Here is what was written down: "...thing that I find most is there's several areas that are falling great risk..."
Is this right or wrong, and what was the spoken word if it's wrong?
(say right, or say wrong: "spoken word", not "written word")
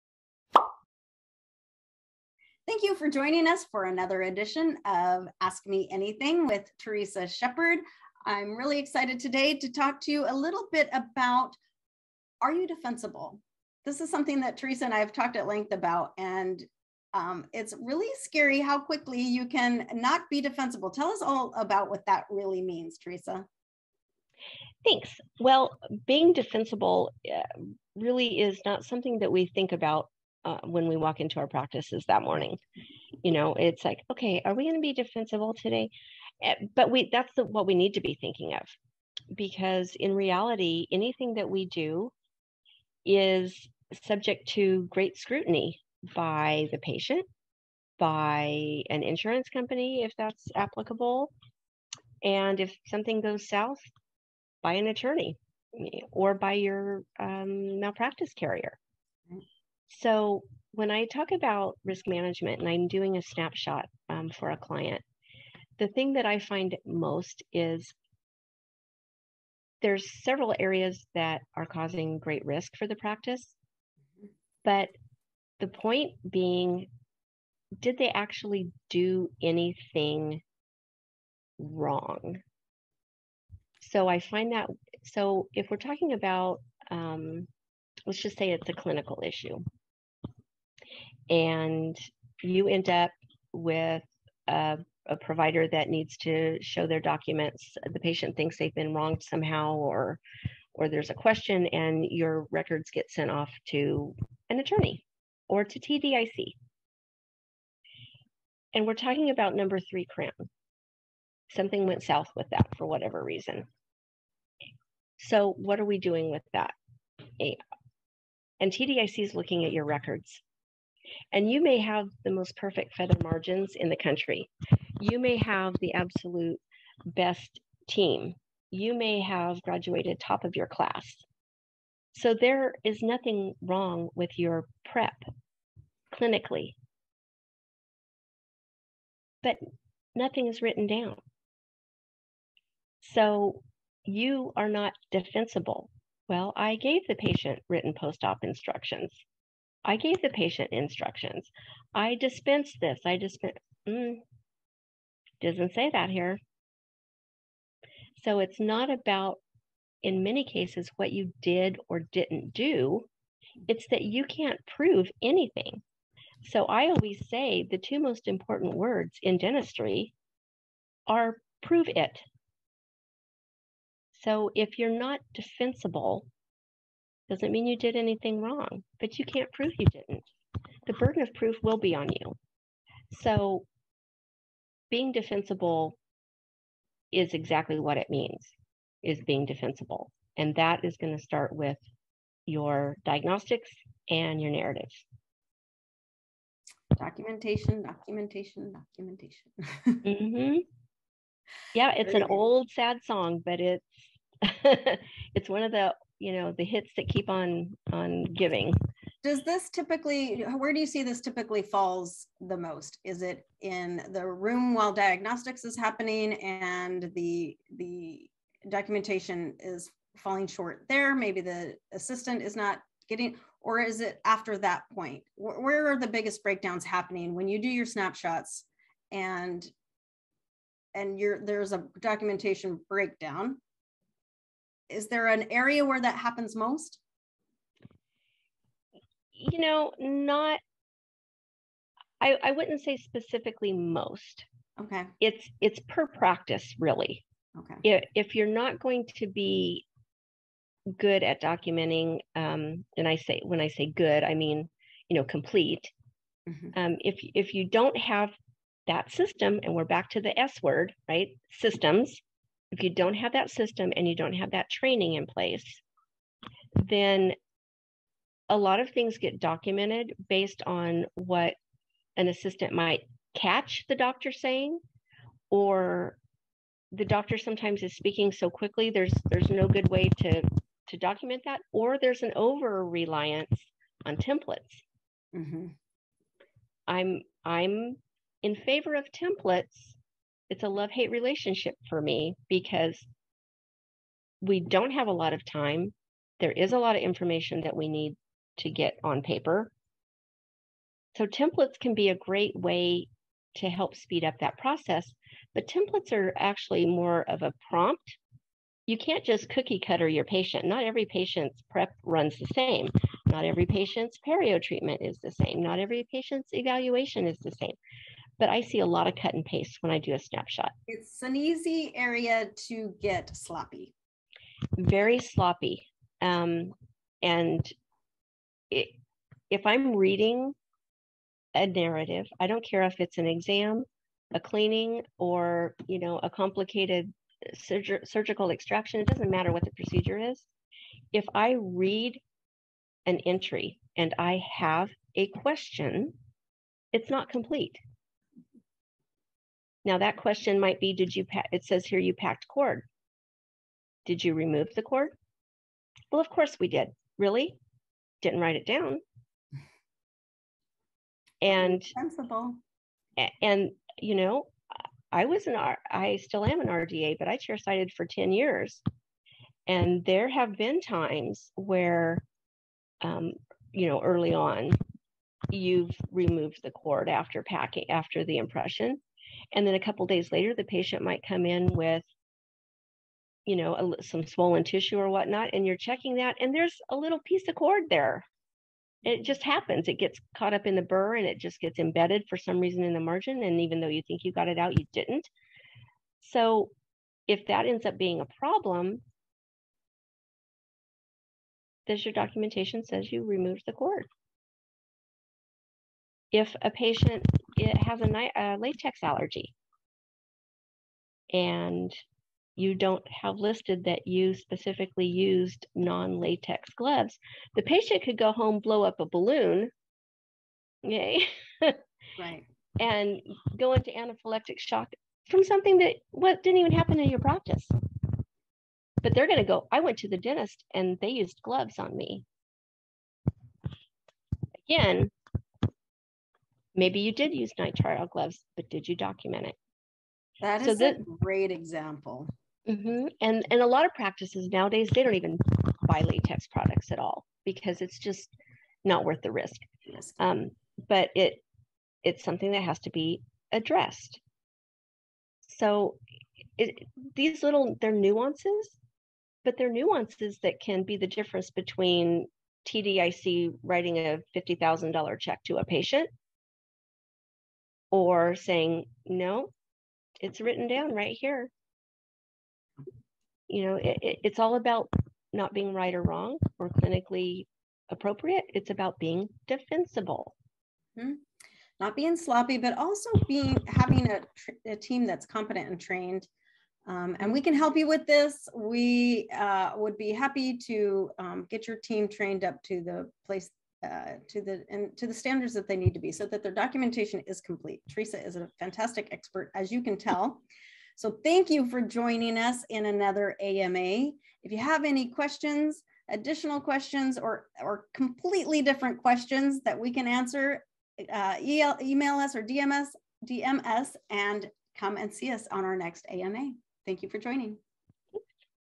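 wrong: "causing", not "falling".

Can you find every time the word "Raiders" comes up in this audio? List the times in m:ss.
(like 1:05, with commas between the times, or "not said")
not said.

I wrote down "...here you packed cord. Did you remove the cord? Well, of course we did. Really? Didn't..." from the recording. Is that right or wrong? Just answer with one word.
right.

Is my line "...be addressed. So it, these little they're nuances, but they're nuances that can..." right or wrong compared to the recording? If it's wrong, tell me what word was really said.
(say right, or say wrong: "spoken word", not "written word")
right.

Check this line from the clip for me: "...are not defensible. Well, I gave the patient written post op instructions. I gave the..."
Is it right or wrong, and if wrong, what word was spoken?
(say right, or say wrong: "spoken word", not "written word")
right.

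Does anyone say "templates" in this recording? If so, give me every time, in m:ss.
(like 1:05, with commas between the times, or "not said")
4:44, 4:49, 5:01, 5:05.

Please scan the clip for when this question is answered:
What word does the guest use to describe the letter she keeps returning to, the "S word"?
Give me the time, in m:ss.
4:21.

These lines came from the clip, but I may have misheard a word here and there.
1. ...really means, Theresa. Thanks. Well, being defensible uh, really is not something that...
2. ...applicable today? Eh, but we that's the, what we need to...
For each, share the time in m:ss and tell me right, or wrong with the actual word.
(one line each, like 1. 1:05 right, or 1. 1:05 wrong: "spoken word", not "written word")
1. 0:22 right
2. 0:34 wrong: "defensible", not "applicable".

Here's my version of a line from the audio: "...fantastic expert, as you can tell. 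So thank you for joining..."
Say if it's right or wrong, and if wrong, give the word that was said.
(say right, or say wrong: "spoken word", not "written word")
right.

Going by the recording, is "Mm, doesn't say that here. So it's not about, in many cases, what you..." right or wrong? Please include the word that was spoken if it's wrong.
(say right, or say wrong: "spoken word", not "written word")
right.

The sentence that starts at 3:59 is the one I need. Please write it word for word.
You know, not I, I wouldn't say specifically most.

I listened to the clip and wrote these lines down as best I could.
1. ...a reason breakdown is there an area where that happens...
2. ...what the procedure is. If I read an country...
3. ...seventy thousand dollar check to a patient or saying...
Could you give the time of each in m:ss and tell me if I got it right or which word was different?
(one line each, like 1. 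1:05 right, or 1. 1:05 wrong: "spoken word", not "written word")
1. 3:51 wrong: "documentation", not "reason"
2. 5:39 wrong: "entry", not "country"
3. 7:44 wrong: "fifty", not "seventy".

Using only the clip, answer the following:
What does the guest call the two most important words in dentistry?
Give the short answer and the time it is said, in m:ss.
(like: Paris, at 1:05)
Prove it, at 2:51.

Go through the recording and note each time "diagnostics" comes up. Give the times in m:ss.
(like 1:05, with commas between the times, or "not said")
3:13, 3:34.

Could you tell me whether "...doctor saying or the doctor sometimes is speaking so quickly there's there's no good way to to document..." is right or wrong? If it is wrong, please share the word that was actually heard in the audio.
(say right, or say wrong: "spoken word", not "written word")
right.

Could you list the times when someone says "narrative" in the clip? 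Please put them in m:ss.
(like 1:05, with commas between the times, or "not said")
3:14, 5:31.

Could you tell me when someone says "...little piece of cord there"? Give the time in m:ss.
6:26.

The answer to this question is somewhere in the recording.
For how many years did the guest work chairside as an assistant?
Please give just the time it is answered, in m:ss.
6:08.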